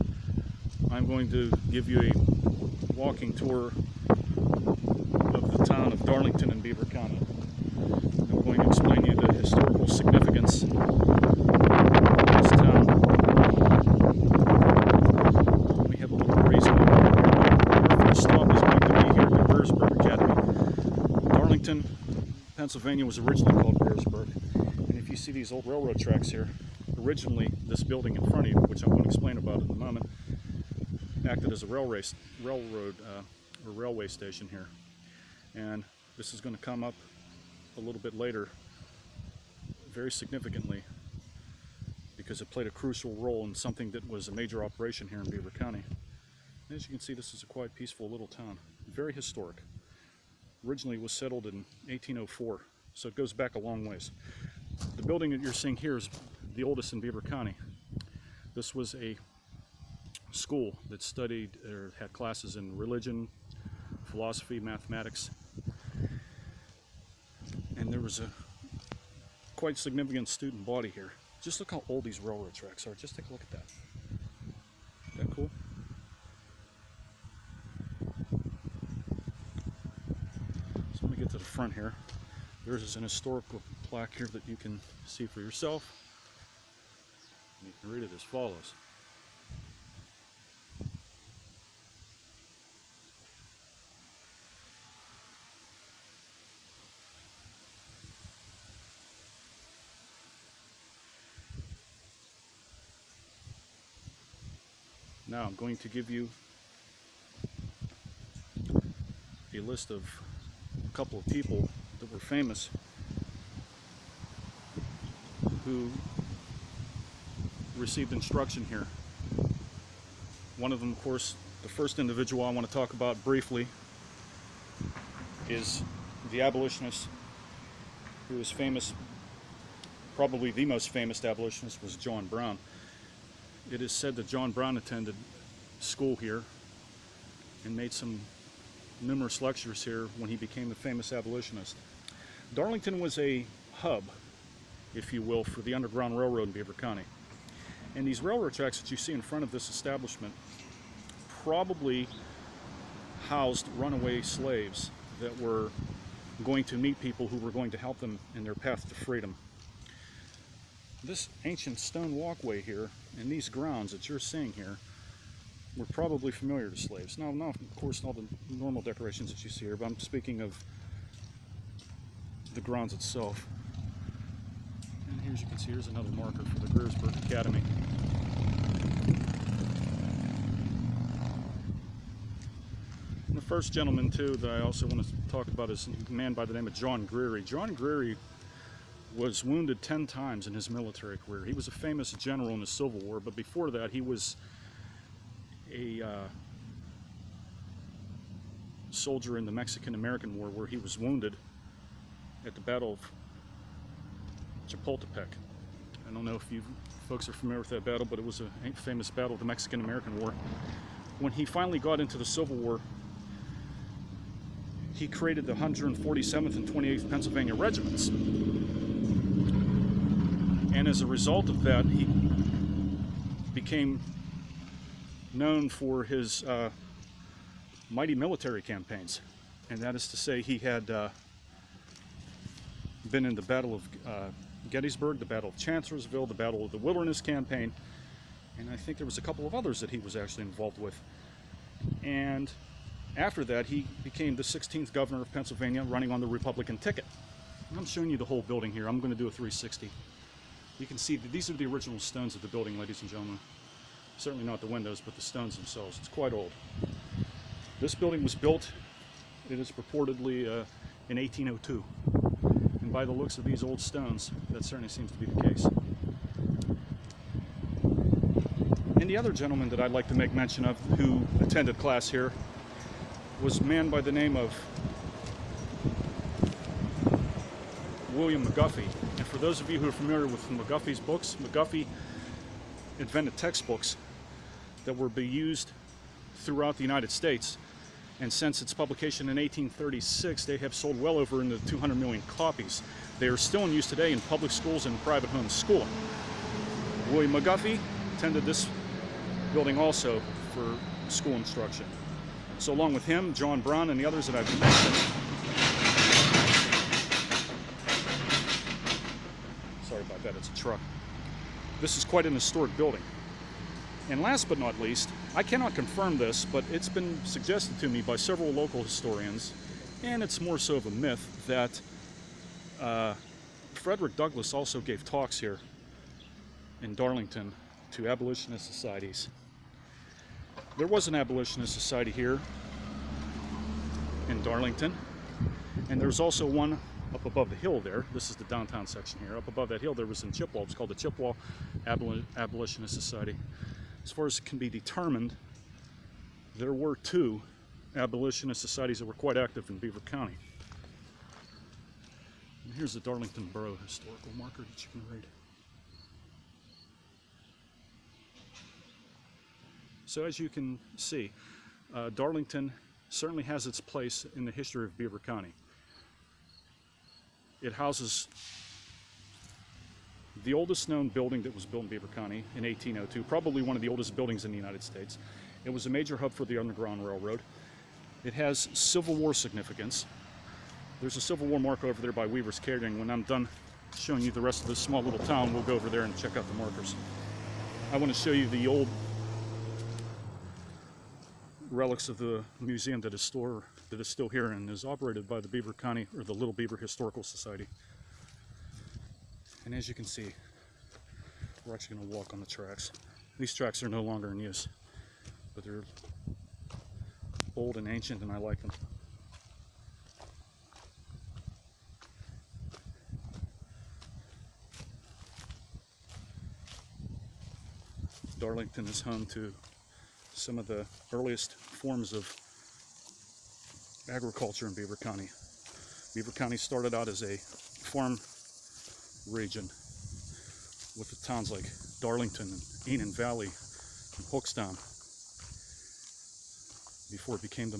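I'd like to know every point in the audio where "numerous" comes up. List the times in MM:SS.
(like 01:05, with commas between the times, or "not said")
02:19.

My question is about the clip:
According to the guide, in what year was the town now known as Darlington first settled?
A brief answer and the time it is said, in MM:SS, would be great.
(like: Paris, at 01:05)
1804, at 00:51.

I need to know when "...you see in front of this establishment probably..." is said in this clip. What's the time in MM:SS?
02:28.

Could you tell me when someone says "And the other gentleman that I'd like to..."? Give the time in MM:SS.
04:28.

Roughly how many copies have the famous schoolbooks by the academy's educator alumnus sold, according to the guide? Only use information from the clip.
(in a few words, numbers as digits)
Over 200 million.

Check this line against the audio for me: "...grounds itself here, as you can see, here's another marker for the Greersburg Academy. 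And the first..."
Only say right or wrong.
right.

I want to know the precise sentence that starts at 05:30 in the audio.
There was an abolitionist society here in Darlington, and there was also one up above the hill there.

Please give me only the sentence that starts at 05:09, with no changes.
Sorry about that, it's a truck.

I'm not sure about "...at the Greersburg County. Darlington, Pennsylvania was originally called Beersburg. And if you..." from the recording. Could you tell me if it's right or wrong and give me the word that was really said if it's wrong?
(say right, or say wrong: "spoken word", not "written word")
wrong: "Academy", not "County".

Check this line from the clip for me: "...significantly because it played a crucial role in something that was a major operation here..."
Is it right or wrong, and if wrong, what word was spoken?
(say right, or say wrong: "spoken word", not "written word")
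right.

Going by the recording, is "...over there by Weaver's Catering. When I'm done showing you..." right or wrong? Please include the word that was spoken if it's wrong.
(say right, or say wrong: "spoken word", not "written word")
right.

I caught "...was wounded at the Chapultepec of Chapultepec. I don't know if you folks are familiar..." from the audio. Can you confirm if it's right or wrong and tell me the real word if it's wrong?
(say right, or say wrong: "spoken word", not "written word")
wrong: "Battle", not "Chapultepec".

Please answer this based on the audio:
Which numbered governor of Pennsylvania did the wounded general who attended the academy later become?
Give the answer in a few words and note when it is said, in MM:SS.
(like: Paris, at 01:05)
16th, at 04:04.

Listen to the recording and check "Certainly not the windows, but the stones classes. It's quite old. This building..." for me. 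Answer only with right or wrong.
wrong.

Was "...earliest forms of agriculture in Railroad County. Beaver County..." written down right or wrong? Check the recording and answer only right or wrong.
wrong.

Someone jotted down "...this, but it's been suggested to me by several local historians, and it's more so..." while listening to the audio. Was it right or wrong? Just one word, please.
right.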